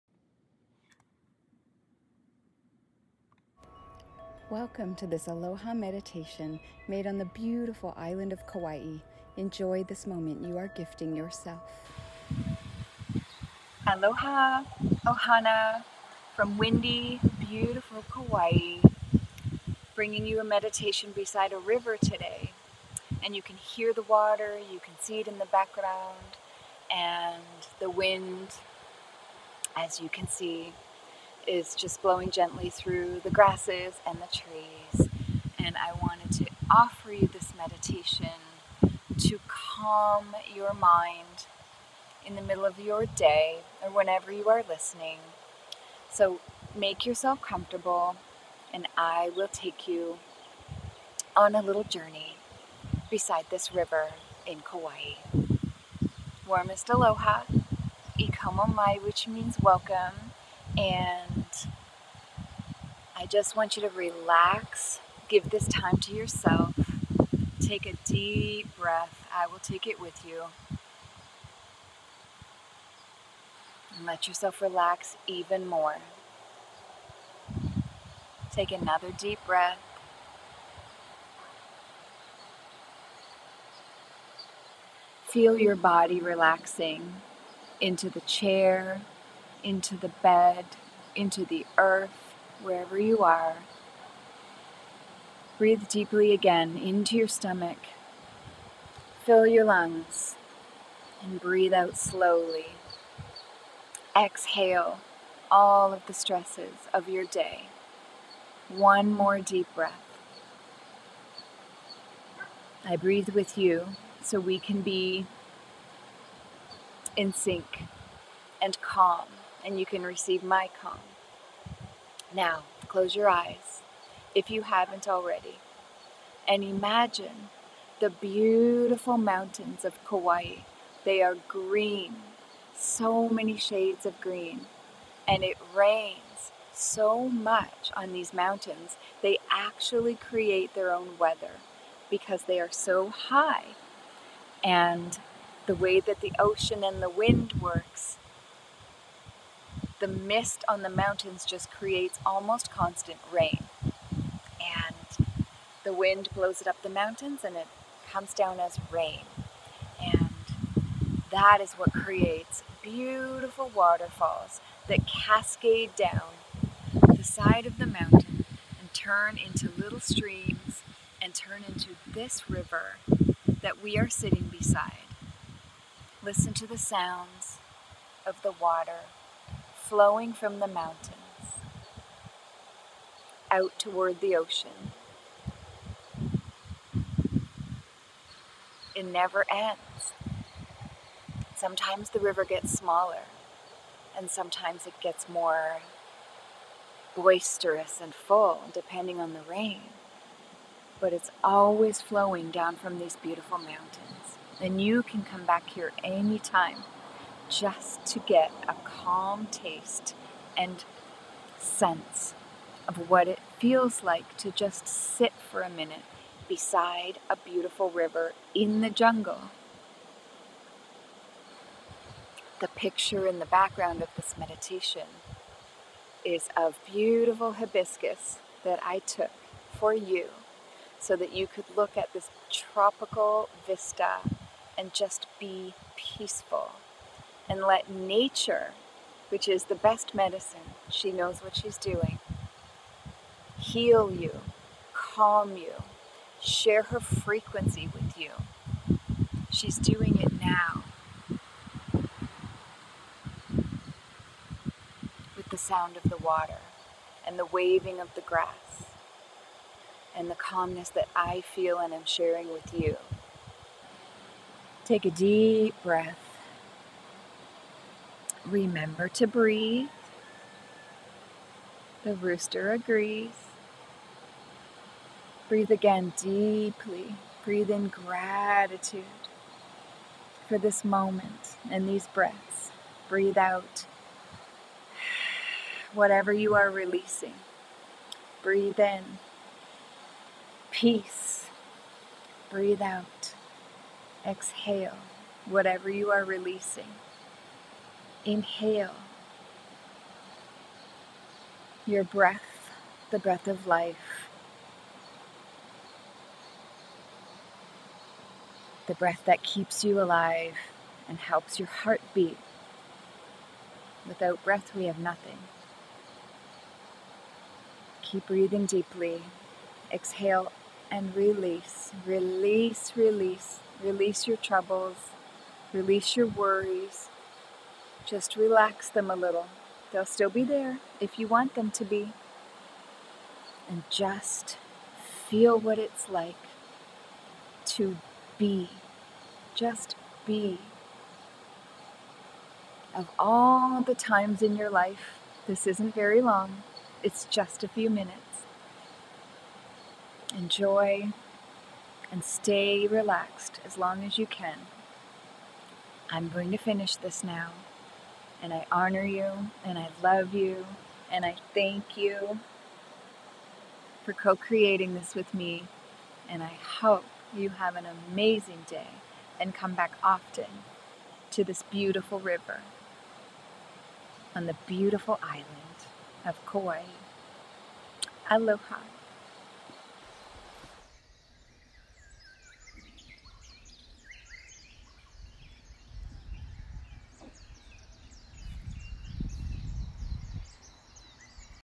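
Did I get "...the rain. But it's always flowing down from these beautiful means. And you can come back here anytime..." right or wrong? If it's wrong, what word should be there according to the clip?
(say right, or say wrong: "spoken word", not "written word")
wrong: "mountains", not "means".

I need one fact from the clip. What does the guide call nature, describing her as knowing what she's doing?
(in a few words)
the best medicine.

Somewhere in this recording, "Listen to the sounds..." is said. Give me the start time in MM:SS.
02:56.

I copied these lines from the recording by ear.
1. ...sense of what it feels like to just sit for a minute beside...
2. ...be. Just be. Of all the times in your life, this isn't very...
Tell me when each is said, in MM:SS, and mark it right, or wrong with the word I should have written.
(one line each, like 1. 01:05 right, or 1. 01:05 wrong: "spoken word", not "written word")
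1. 03:31 right
2. 05:38 right.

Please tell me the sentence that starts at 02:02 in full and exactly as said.
Now, close your eyes if you haven't already and imagine the beautiful mountains of Kauai.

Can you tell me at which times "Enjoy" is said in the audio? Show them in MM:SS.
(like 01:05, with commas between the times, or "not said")
00:09, 05:50.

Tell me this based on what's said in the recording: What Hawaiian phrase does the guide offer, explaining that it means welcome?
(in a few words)
ikomo mai.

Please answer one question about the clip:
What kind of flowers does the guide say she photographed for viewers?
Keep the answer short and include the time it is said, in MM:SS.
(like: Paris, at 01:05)
hibiscus, at 03:47.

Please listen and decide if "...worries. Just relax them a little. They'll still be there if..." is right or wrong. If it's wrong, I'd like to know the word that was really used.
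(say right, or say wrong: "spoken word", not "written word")
right.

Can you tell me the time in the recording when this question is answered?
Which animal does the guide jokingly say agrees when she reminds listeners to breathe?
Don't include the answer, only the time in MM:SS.
04:32.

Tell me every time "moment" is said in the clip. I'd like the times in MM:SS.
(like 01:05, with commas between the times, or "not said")
00:10, 04:40.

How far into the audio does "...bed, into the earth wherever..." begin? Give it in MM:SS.
01:30.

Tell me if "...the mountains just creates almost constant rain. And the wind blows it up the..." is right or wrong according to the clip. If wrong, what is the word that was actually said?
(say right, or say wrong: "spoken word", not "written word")
right.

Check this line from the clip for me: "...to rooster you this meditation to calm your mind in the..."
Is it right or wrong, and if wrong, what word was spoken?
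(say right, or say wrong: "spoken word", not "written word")
wrong: "offer", not "rooster".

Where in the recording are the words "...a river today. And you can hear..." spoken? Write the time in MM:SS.
00:21.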